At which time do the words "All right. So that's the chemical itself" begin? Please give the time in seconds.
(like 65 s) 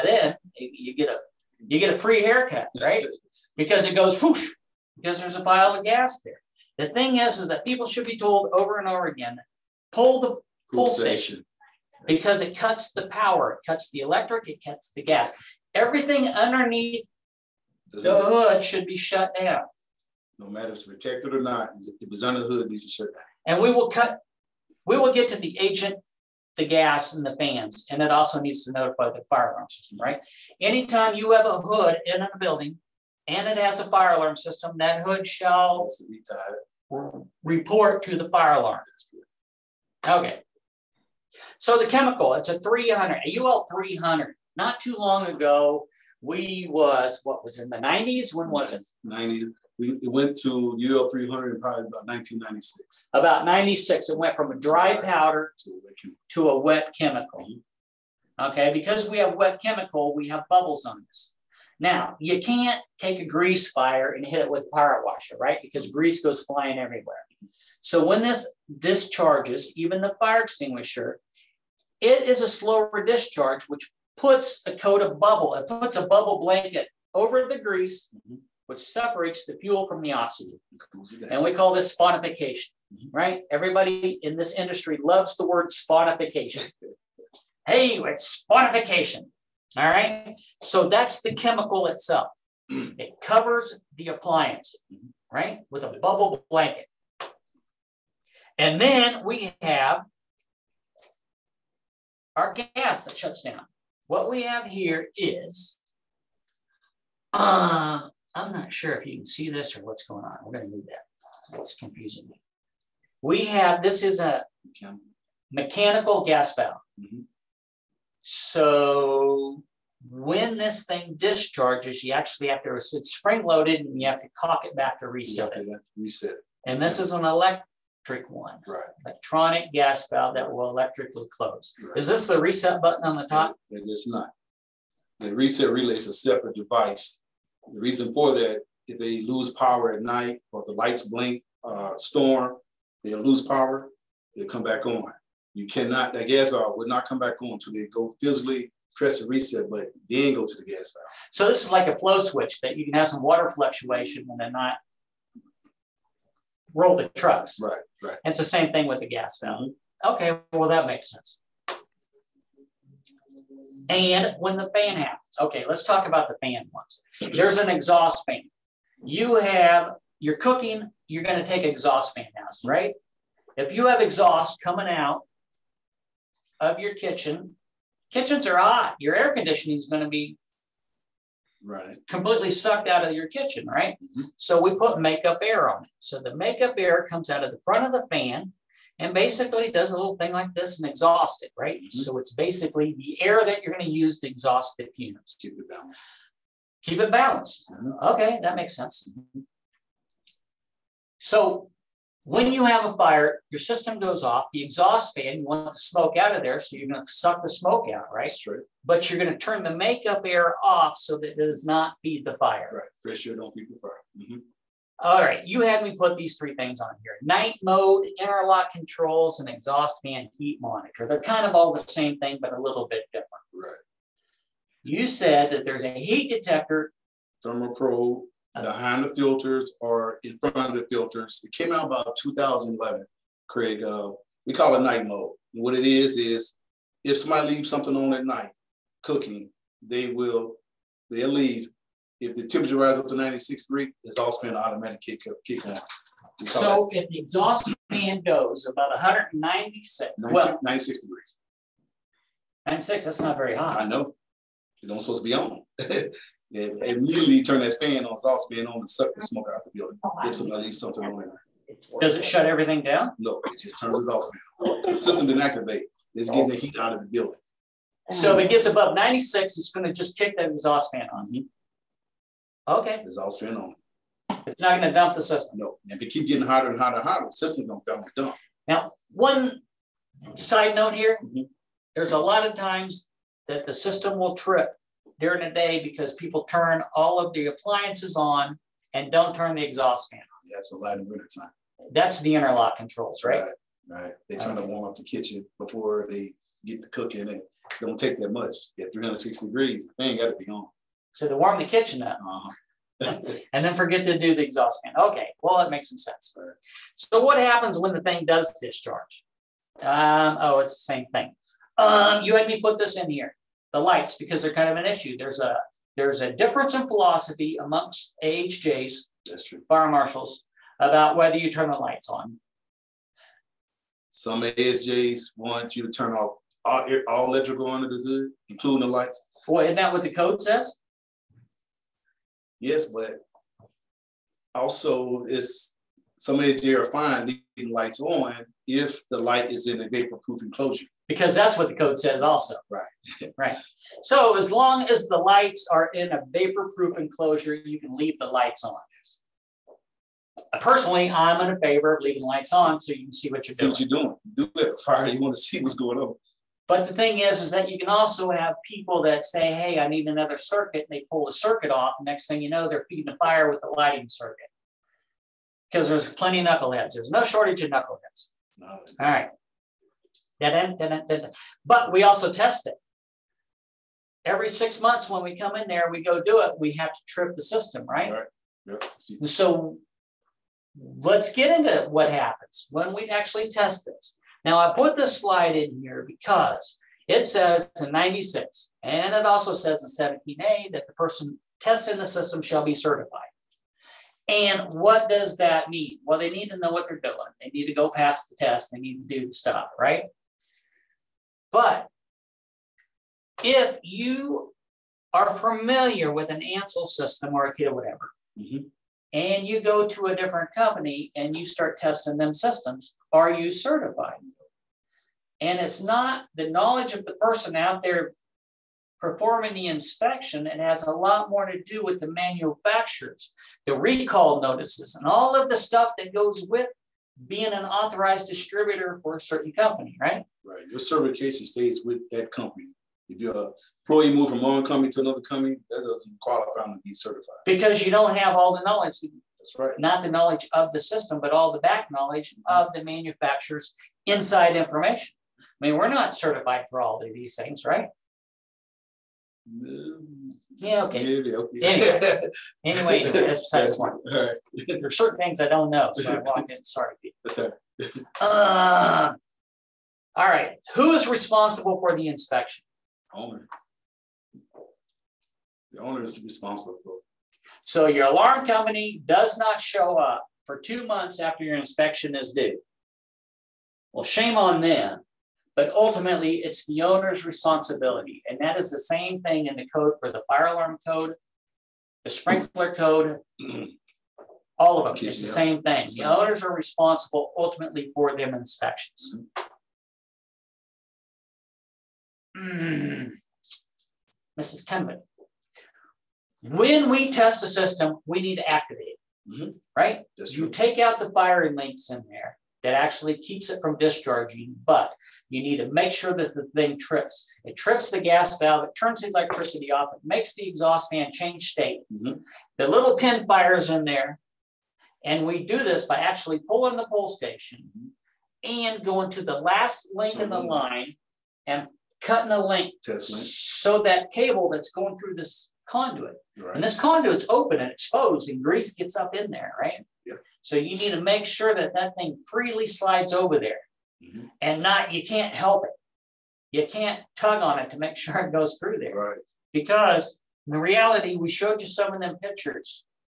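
89 s.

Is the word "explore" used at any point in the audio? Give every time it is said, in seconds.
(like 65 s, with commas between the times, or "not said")
not said.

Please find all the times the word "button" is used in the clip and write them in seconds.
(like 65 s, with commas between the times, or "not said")
132 s, 149 s.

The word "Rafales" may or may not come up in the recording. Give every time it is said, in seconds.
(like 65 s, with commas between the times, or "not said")
not said.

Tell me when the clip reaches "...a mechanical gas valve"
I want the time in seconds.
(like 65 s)
114 s.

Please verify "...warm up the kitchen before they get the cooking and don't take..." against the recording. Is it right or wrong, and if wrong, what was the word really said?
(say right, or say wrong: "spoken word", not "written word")
right.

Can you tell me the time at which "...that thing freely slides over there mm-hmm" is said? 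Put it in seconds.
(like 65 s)
531 s.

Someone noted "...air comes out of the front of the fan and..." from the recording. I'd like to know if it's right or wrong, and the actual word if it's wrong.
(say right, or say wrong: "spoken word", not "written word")
right.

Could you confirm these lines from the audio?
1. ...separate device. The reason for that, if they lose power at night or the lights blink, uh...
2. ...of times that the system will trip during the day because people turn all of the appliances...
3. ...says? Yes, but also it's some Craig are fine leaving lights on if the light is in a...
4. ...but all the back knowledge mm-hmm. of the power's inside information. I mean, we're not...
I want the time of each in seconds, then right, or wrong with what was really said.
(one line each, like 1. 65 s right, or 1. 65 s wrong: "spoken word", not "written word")
1. 136 s right
2. 282 s right
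3. 330 s wrong: "AHJ", not "Craig"
4. 441 s wrong: "manufacturer", not "power".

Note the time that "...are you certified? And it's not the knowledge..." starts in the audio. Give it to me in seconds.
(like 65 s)
413 s.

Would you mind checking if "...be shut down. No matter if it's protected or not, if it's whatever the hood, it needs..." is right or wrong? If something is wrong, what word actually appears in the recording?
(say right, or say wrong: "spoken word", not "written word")
wrong: "under", not "whatever".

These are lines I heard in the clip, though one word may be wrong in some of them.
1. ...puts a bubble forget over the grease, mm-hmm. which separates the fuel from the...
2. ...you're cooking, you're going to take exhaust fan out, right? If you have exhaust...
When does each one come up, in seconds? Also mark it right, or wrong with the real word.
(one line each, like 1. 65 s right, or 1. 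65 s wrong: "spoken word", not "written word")
1. 75 s wrong: "blanket", not "forget"
2. 170 s right.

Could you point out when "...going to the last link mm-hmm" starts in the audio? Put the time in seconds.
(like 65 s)
518 s.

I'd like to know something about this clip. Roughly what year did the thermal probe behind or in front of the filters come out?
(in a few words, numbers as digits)
2011.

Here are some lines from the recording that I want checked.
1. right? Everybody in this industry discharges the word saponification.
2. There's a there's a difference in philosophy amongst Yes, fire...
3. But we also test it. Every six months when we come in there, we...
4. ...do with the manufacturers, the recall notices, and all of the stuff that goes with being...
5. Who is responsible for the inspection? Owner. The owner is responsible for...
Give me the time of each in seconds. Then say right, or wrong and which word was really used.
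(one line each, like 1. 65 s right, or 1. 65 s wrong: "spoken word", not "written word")
1. 83 s wrong: "loves", not "discharges"
2. 315 s wrong: "AHJs", not "Yes"
3. 370 s right
4. 421 s right
5. 460 s right.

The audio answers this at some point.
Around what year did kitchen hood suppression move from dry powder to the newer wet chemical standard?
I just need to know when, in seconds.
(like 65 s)
52 s.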